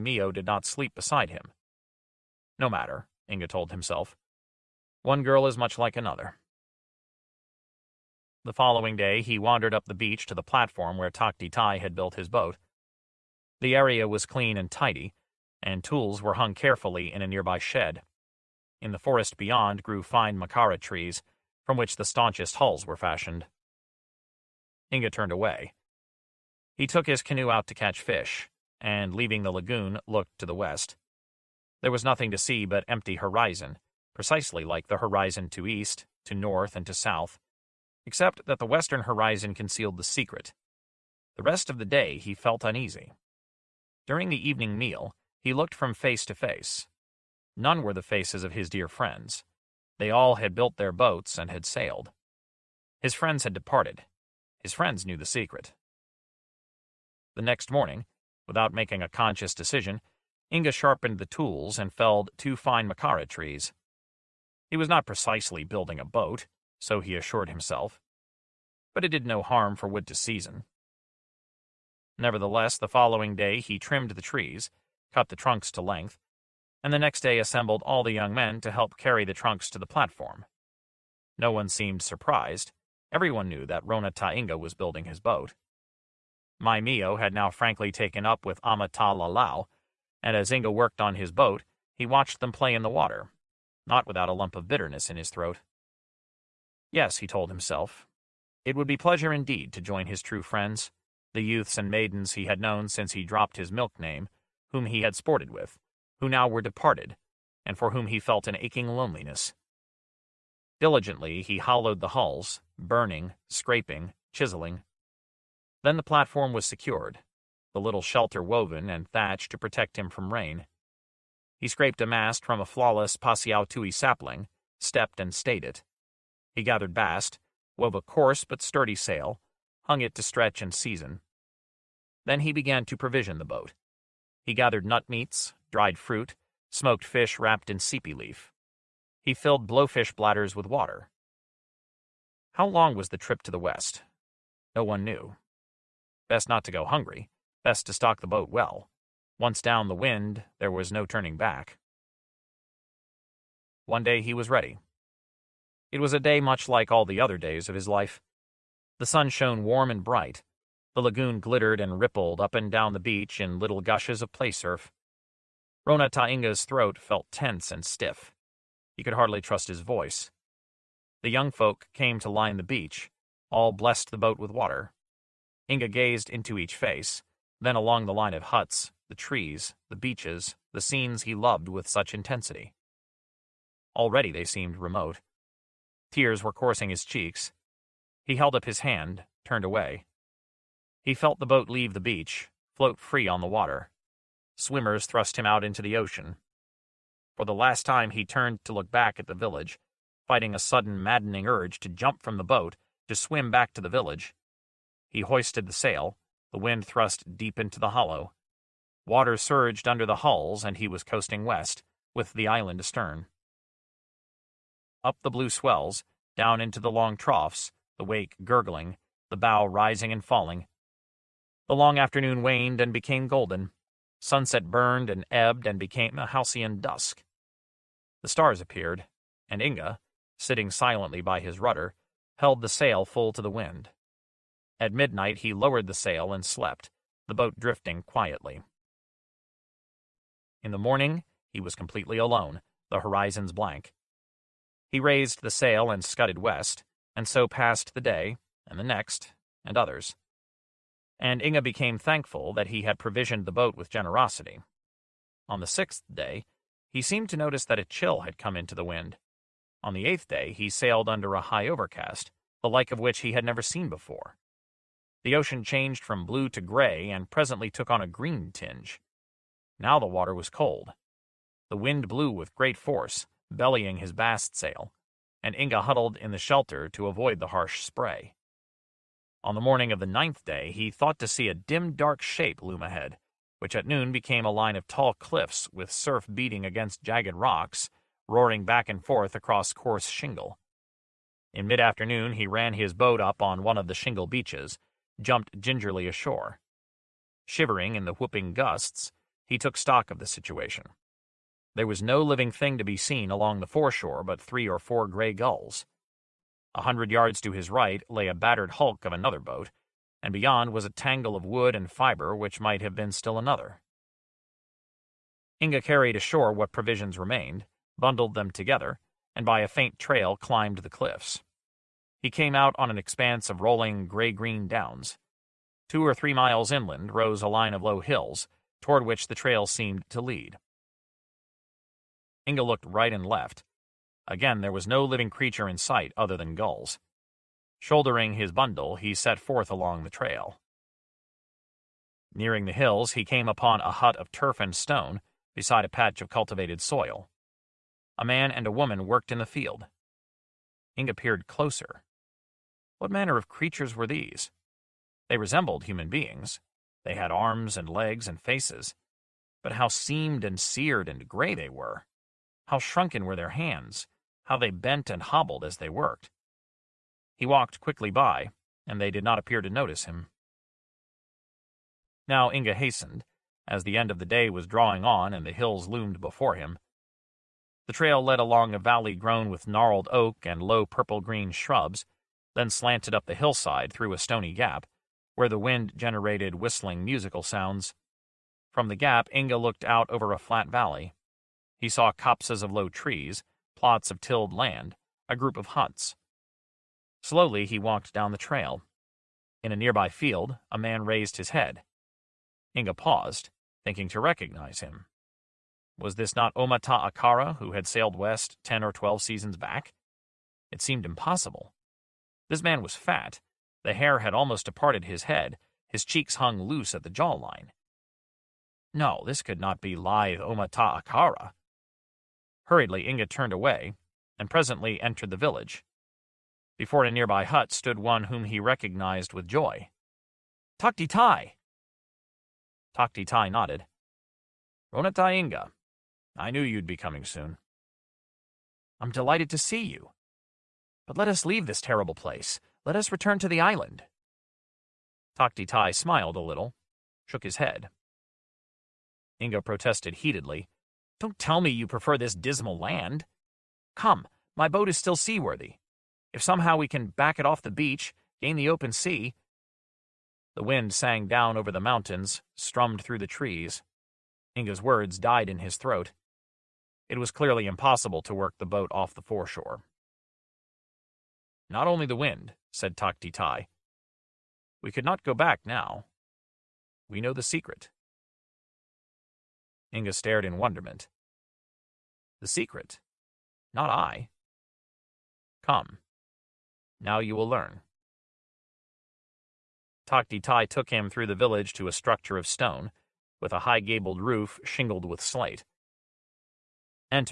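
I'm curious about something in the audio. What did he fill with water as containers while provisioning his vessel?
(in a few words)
blowfish bladders.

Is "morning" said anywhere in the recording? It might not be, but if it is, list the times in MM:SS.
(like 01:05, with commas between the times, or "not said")
00:57, 04:00, 04:39.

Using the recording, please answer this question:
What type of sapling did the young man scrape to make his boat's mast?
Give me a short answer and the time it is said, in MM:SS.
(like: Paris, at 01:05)
Pasiautui, at 02:03.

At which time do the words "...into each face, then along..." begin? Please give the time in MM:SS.
02:56.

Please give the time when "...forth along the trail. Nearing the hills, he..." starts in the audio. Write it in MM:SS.
05:39.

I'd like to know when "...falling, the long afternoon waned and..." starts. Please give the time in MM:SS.
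03:40.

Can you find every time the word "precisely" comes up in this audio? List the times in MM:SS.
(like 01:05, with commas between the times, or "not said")
00:34, 01:05.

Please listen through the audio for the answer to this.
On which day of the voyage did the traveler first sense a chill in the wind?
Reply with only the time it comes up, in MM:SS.
04:15.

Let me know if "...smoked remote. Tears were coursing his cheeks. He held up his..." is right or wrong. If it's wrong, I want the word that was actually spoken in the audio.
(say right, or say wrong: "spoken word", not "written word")
wrong: "seemed", not "smoked".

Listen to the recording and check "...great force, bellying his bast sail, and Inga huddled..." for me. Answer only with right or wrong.
right.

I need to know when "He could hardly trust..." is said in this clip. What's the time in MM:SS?
02:48.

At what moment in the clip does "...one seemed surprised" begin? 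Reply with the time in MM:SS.
01:21.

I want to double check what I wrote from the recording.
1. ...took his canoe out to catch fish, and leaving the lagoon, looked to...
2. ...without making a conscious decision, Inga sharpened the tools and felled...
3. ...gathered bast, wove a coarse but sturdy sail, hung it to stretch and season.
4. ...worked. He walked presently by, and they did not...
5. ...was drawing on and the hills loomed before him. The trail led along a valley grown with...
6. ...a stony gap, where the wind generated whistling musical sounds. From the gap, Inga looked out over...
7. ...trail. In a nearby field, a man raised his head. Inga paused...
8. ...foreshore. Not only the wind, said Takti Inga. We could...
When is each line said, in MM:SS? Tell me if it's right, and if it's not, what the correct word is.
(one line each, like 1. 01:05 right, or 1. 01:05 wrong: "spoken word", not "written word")
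1. 00:26 right
2. 00:58 right
3. 02:06 right
4. 06:05 wrong: "quickly", not "presently"
5. 06:14 right
6. 06:24 right
7. 06:38 right
8. 07:49 wrong: "Tai", not "Inga".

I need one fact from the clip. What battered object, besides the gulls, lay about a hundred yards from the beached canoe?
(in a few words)
another boat.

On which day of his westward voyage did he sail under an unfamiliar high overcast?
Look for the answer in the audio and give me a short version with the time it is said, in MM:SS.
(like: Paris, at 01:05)
8th day, at 04:20.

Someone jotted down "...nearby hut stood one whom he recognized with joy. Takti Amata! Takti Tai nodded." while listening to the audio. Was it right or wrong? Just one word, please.
wrong.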